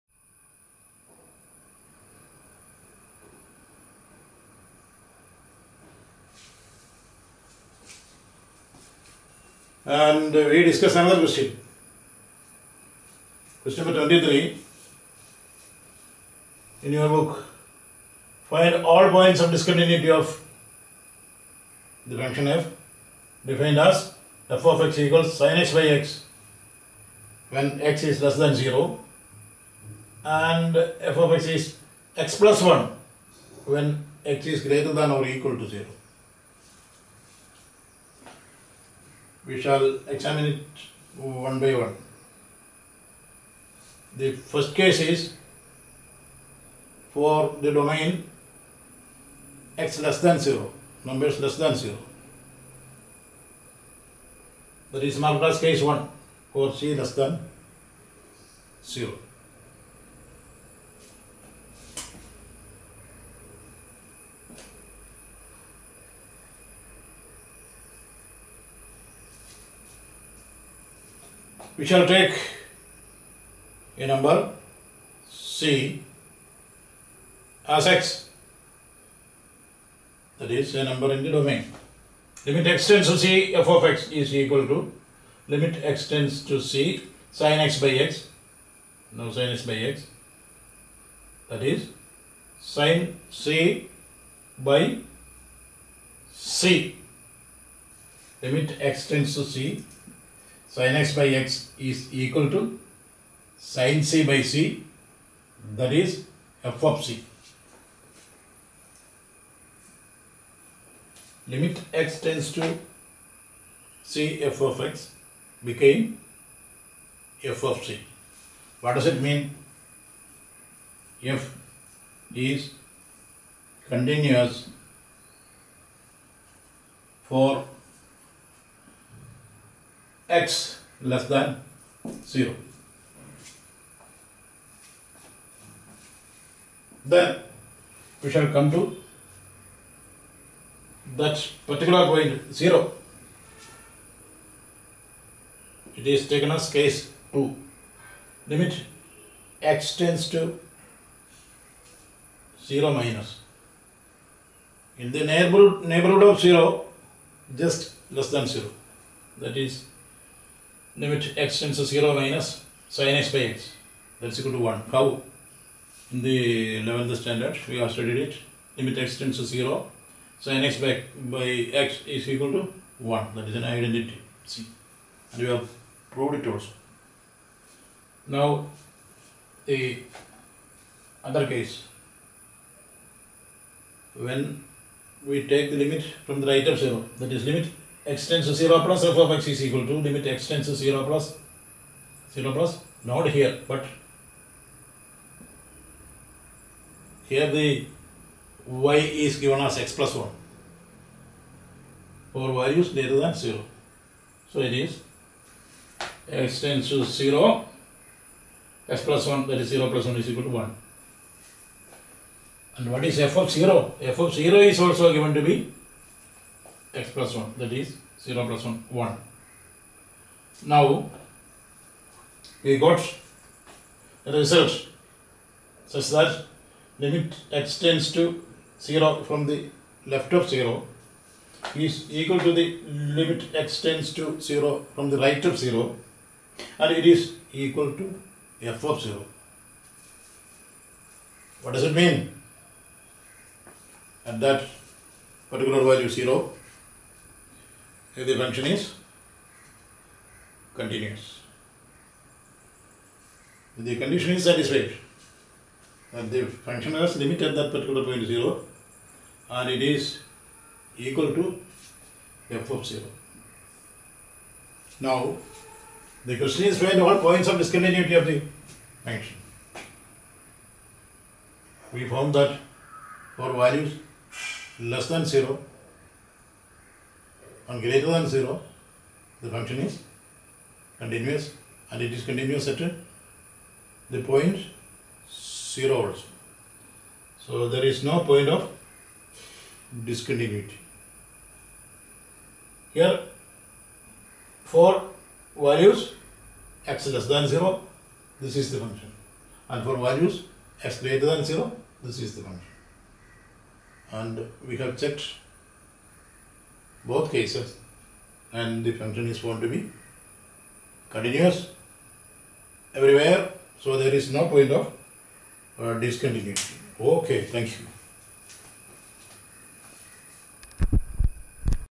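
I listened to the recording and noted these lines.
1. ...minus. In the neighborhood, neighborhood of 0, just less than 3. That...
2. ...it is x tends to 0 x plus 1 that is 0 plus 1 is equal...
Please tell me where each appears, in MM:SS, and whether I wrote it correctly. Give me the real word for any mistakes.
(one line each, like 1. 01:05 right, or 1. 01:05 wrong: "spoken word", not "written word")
1. 02:32 wrong: "0", not "3"
2. 03:24 right.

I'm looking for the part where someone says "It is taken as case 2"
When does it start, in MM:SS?
02:25.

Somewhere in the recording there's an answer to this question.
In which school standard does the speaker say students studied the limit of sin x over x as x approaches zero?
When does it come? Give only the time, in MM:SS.
02:46.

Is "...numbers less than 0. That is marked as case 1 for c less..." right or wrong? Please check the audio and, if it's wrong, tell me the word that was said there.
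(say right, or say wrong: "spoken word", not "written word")
right.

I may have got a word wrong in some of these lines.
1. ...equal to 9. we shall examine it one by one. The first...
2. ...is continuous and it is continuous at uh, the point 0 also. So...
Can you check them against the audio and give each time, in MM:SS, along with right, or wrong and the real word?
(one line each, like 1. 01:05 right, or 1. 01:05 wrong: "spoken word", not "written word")
1. 00:35 wrong: "0", not "9"
2. 04:39 right.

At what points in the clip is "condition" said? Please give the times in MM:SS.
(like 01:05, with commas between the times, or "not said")
04:13.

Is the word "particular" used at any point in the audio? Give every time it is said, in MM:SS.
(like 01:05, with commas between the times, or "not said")
02:21, 04:05, 04:17.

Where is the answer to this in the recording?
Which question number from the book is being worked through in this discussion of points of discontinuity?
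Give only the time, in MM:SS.
00:13.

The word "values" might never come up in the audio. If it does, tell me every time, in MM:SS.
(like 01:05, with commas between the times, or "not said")
04:05, 04:33, 04:55, 04:59.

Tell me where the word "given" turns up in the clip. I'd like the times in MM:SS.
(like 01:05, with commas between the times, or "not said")
03:19, 03:35.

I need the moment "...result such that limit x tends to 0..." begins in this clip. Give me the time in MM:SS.
03:44.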